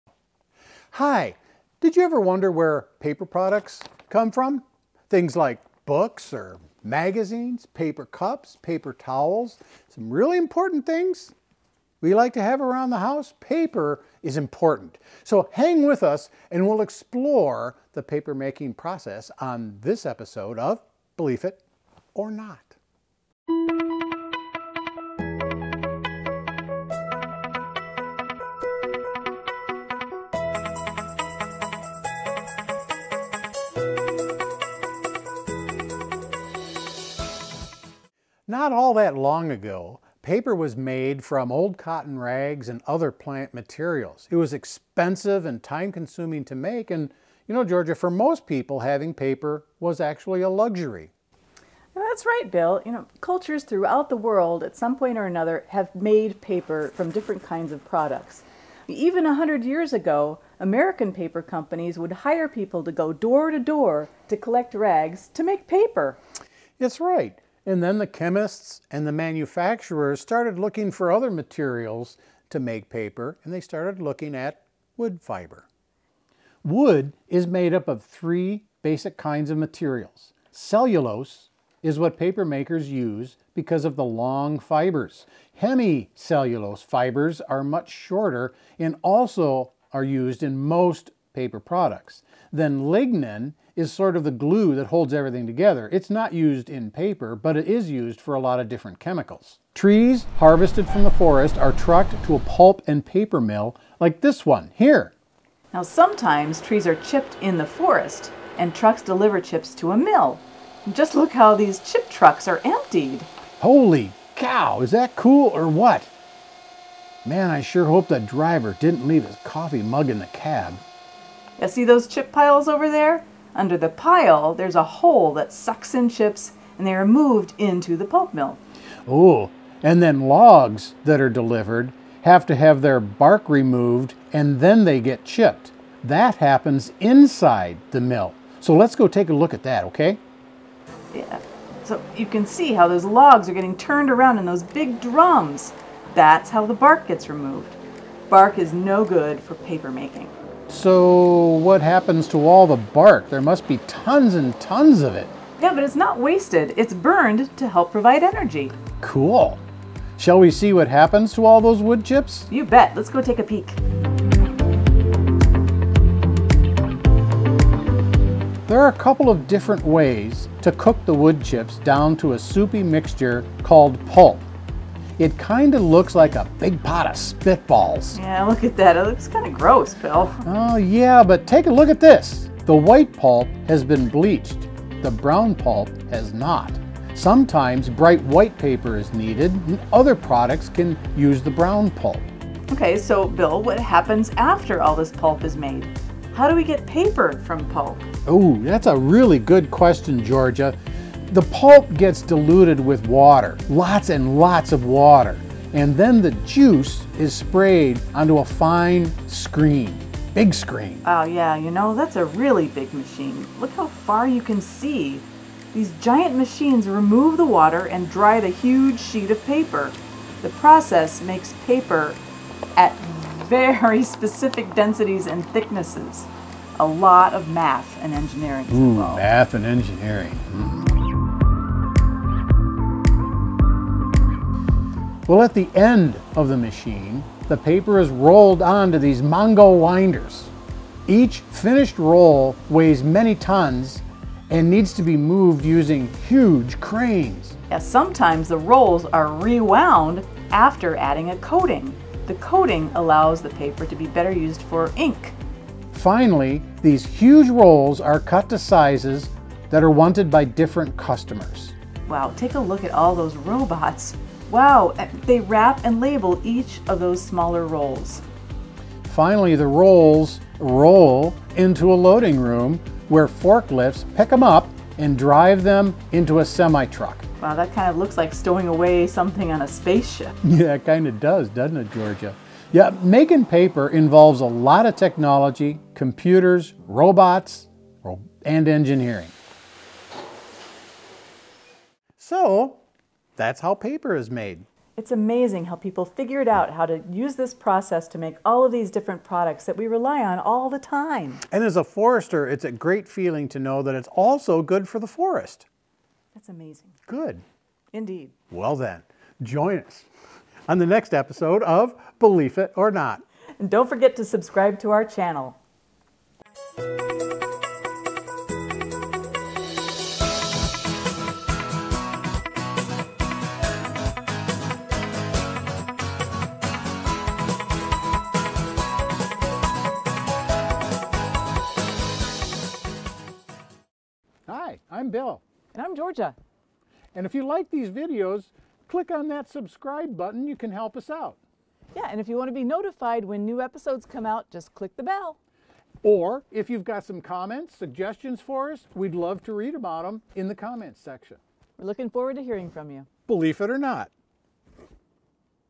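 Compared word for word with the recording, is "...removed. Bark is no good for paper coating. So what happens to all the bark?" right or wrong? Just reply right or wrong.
wrong.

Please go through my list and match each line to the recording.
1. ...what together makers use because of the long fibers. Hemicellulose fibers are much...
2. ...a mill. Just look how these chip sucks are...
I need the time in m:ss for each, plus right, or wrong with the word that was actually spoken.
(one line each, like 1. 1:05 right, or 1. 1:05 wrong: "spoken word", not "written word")
1. 1:21 wrong: "paper", not "together"
2. 1:49 wrong: "trucks", not "sucks".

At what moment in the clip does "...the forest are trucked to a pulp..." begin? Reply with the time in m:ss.
1:41.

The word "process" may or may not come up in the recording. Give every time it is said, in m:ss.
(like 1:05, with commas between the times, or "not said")
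0:18, 3:40, 4:57.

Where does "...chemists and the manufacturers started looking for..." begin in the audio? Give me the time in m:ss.
1:08.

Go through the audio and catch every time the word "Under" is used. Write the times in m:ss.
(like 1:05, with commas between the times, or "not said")
2:03.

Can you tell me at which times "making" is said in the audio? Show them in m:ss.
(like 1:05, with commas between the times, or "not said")
0:18, 2:29, 4:43.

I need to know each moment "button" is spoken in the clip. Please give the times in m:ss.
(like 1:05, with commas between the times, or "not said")
5:40.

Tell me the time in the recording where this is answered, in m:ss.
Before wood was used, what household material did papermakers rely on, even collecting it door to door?
0:41.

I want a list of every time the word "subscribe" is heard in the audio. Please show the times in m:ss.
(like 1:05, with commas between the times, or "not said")
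5:14, 5:39.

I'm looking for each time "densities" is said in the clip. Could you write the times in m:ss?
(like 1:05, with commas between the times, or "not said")
3:44.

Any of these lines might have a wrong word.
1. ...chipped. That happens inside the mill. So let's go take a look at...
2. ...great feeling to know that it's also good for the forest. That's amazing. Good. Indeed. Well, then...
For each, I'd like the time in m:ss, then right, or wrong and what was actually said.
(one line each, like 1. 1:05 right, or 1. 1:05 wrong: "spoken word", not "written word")
1. 2:15 right
2. 5:02 right.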